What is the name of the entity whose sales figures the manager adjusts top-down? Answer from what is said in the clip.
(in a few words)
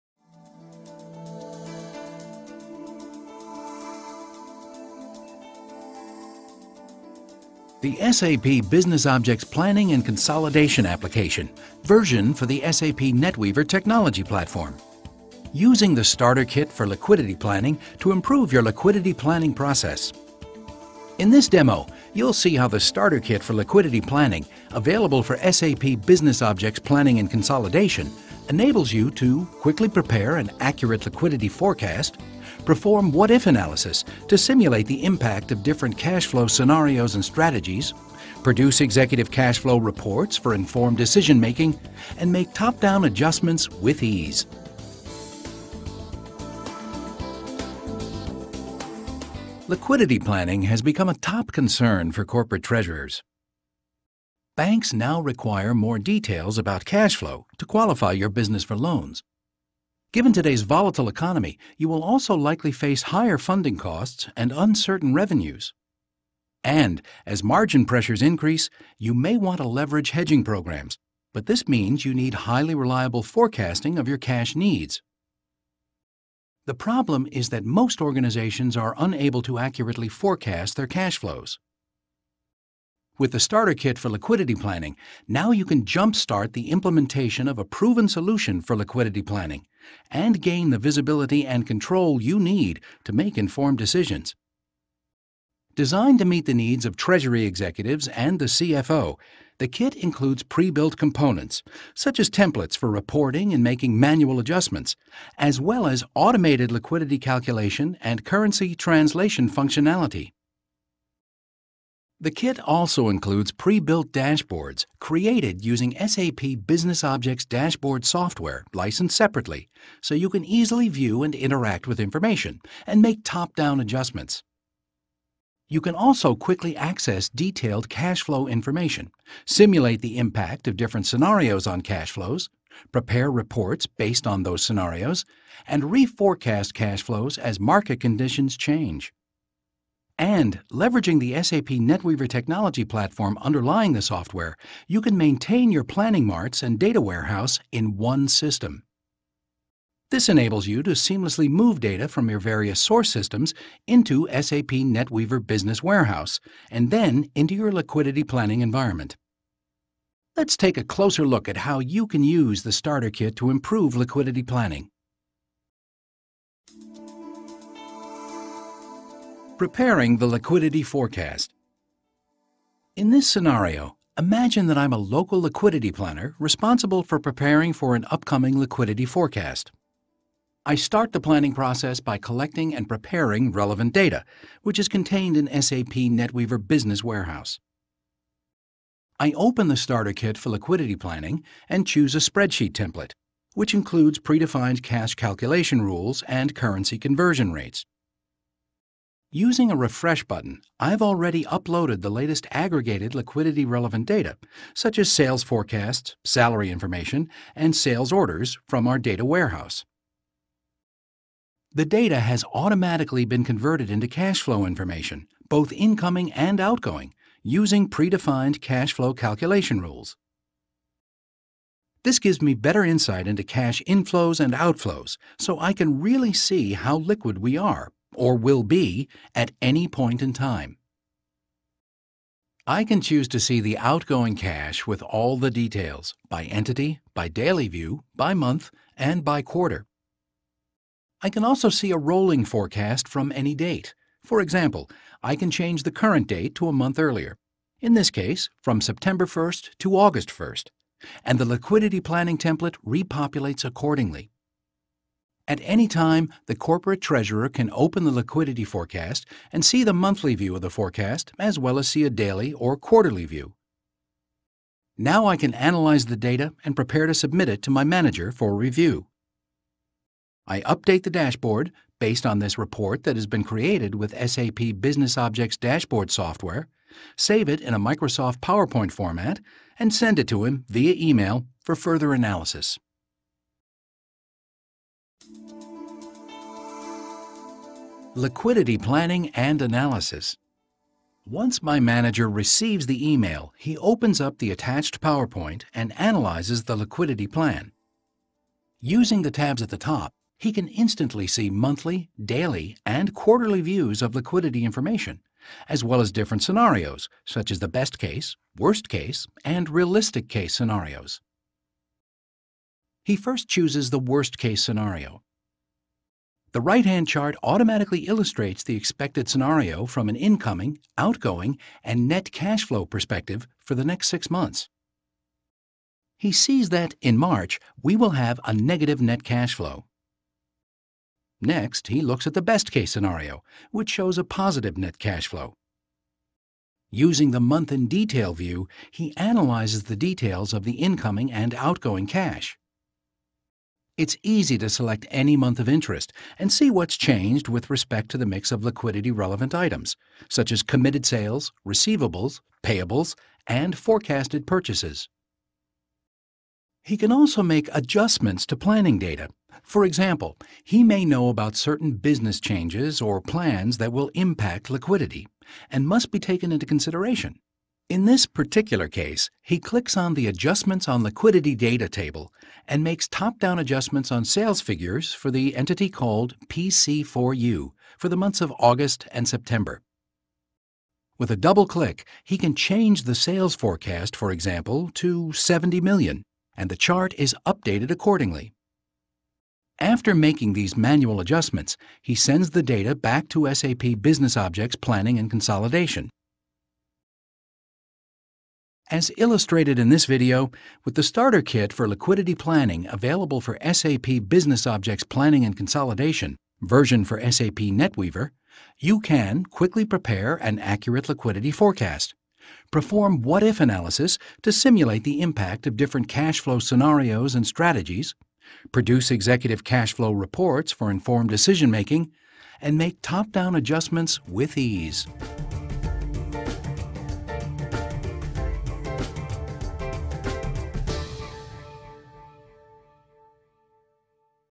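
PC4U.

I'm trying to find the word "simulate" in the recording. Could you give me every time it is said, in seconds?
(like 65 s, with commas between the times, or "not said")
34 s, 129 s, 414 s.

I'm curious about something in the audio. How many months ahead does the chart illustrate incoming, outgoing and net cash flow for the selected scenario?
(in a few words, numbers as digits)
6.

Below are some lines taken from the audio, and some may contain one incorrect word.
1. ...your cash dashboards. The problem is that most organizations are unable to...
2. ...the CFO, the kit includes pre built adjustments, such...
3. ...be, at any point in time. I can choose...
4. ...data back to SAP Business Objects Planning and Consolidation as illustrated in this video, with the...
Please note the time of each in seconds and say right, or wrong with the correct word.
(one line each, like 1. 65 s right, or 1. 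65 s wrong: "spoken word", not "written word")
1. 74 s wrong: "needs", not "dashboards"
2. 98 s wrong: "components", not "adjustments"
3. 228 s right
4. 392 s right.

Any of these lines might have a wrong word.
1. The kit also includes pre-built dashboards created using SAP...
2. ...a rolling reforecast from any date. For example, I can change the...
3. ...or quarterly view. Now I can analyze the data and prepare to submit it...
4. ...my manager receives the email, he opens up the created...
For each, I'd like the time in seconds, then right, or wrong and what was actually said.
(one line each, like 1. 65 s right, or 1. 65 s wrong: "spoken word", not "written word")
1. 112 s right
2. 241 s wrong: "forecast", not "reforecast"
3. 262 s right
4. 291 s wrong: "attached", not "created".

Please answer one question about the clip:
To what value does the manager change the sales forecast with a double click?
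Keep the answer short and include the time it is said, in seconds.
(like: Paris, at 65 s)
70 million, at 385 s.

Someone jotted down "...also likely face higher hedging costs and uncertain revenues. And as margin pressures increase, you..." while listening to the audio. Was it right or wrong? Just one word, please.
wrong.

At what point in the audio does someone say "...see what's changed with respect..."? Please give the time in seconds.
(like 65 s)
346 s.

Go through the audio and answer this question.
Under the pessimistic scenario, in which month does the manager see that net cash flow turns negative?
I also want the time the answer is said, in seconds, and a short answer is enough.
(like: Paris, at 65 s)
March, at 327 s.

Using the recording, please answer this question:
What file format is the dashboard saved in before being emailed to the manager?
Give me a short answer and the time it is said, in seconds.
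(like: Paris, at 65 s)
Microsoft PowerPoint, at 277 s.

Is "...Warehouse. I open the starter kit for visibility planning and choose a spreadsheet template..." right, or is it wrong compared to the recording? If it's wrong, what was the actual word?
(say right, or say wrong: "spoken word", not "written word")
wrong: "liquidity", not "visibility".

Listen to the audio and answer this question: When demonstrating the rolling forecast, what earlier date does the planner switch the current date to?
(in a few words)
August 1st.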